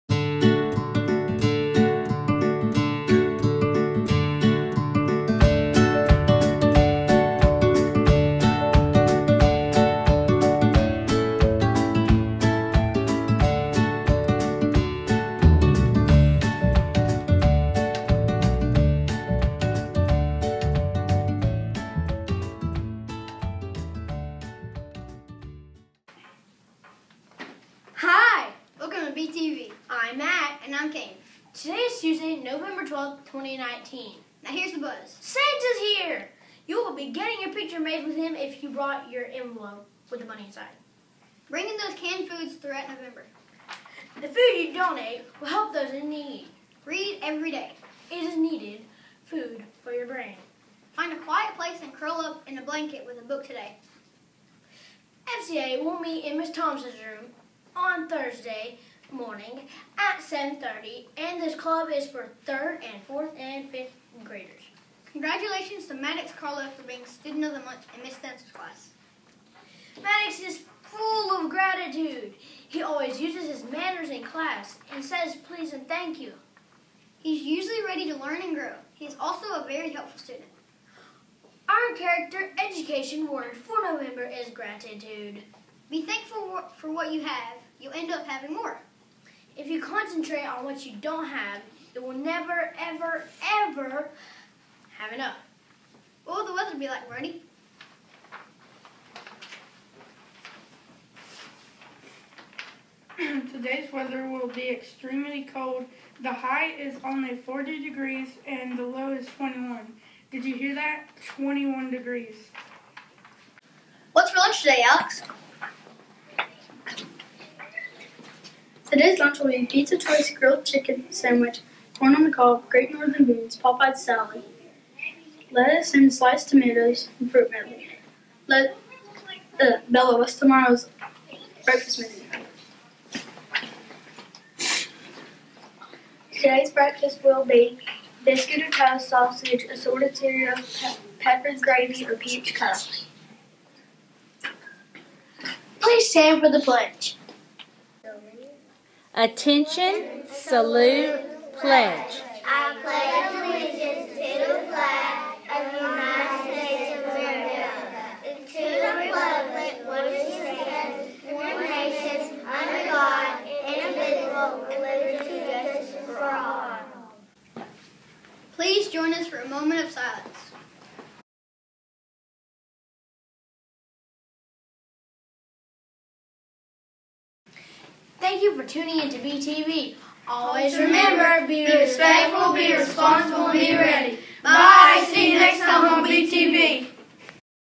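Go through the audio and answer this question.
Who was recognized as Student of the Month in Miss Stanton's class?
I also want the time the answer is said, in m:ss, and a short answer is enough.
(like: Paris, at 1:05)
Maddox Carlo, at 1:05.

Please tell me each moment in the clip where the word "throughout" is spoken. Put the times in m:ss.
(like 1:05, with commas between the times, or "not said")
0:42.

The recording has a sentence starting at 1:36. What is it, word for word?
What will the weather be like, Brody?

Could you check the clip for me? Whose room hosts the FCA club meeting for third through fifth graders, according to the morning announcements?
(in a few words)
Miss Thompson.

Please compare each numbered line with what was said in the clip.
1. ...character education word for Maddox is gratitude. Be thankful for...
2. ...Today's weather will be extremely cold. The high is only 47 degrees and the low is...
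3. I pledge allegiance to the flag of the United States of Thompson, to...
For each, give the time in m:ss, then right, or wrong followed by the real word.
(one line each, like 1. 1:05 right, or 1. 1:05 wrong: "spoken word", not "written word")
1. 1:21 wrong: "November", not "Maddox"
2. 1:43 wrong: "40", not "47"
3. 2:32 wrong: "America", not "Thompson".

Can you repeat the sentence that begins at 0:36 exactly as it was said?
You will be getting your picture made with him if you brought your envelope with the money inside.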